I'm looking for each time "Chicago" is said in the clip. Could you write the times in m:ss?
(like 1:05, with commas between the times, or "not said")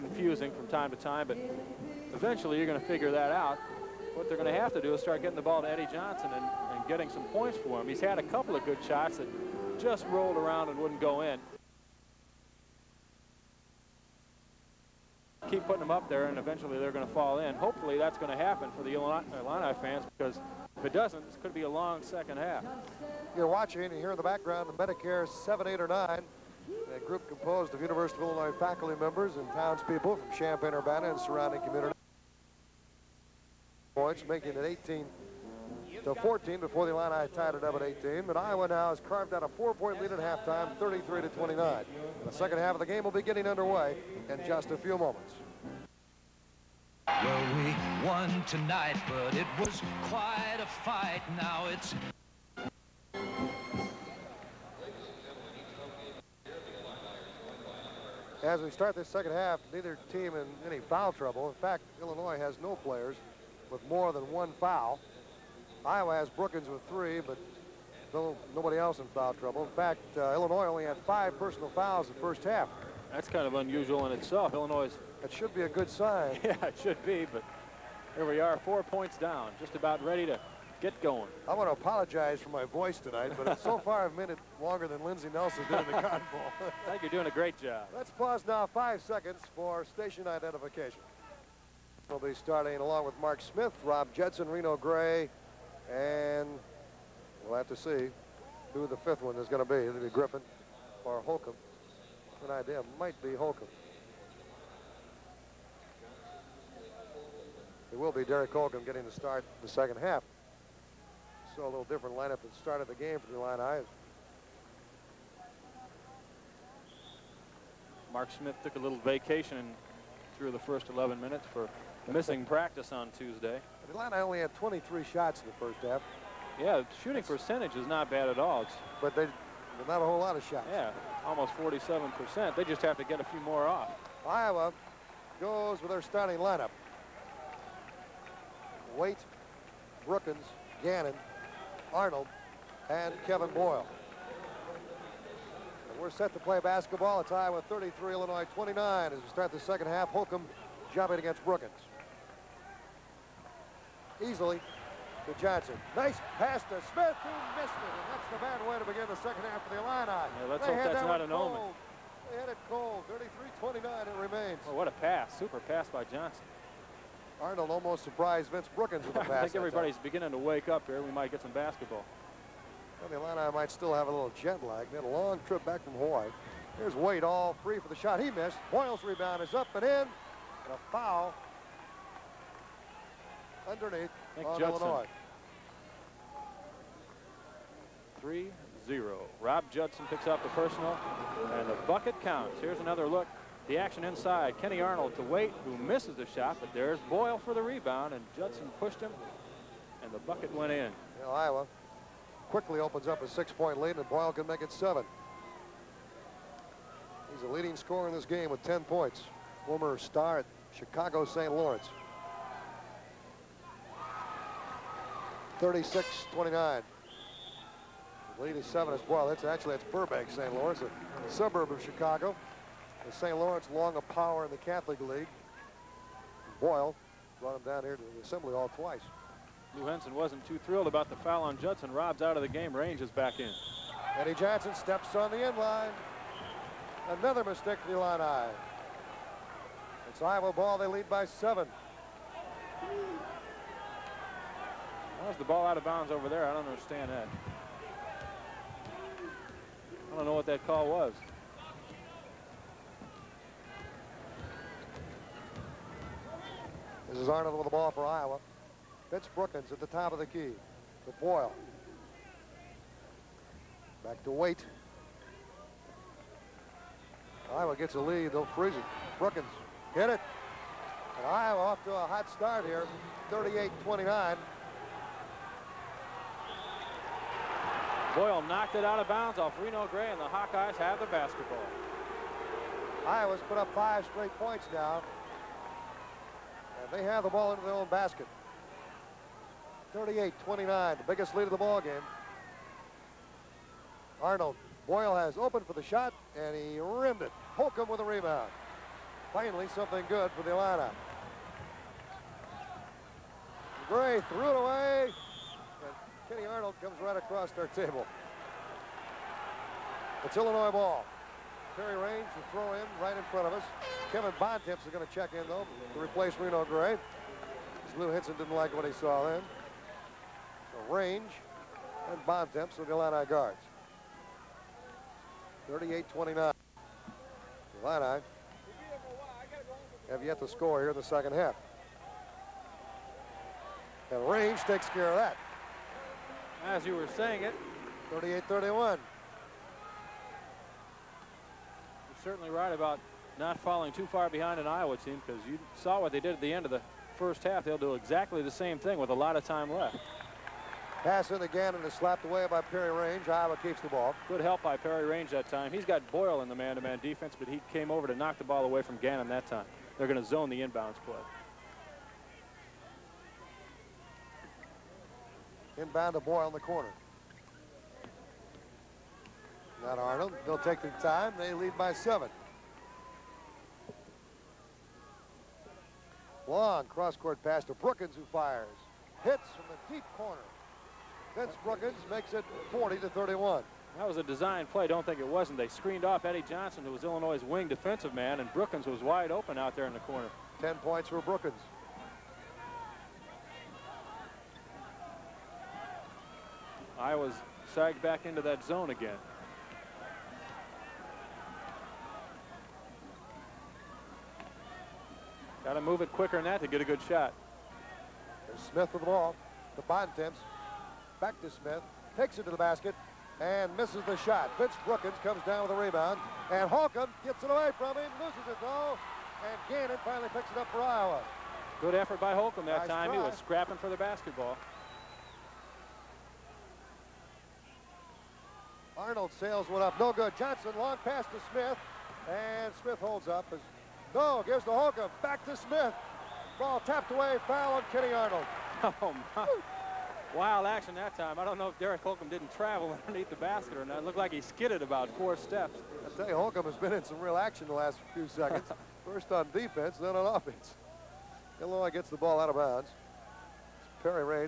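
3:30, 3:41.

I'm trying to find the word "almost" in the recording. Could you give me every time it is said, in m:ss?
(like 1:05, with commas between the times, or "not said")
2:11, 2:47.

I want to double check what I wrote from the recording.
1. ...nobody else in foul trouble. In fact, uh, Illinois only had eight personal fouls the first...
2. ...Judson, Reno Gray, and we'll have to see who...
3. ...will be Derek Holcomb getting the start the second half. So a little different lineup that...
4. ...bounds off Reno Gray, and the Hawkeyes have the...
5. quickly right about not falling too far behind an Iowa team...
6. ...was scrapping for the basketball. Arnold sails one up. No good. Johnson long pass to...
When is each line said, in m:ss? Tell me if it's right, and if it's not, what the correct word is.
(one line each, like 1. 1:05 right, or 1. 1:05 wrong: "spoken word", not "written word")
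1. 1:08 wrong: "five", not "eight"
2. 1:34 right
3. 1:48 right
4. 4:39 right
5. 5:42 wrong: "certainly", not "quickly"
6. 7:03 right.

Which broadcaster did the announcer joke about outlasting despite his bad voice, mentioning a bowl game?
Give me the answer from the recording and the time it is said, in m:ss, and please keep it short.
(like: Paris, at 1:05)
Lindsey Nelson, at 1:25.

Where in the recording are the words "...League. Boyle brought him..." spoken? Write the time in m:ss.
3:44.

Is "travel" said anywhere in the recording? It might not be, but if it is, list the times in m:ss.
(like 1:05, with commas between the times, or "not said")
7:22.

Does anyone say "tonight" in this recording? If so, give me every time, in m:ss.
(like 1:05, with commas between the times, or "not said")
0:48, 1:22.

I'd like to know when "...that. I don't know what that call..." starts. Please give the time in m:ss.
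4:07.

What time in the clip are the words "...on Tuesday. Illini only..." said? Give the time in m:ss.
2:02.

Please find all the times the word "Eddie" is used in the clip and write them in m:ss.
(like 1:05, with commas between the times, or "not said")
0:05, 3:54, 6:26.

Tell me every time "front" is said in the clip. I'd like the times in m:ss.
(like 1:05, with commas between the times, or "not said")
5:13.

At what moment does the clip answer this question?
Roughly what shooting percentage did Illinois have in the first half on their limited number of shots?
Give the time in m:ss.
2:11.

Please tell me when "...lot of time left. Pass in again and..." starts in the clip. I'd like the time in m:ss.
5:49.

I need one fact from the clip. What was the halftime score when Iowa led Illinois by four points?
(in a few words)
33-29.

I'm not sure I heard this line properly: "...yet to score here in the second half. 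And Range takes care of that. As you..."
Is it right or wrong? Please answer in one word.
right.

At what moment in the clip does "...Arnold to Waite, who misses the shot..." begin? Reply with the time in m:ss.
3:14.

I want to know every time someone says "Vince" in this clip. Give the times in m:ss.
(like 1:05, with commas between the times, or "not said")
2:48, 4:19, 6:21, 6:54.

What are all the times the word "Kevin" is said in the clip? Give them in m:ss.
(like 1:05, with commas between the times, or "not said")
2:23, 5:14.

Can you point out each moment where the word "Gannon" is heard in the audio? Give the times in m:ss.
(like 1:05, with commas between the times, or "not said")
2:20, 5:58, 6:59.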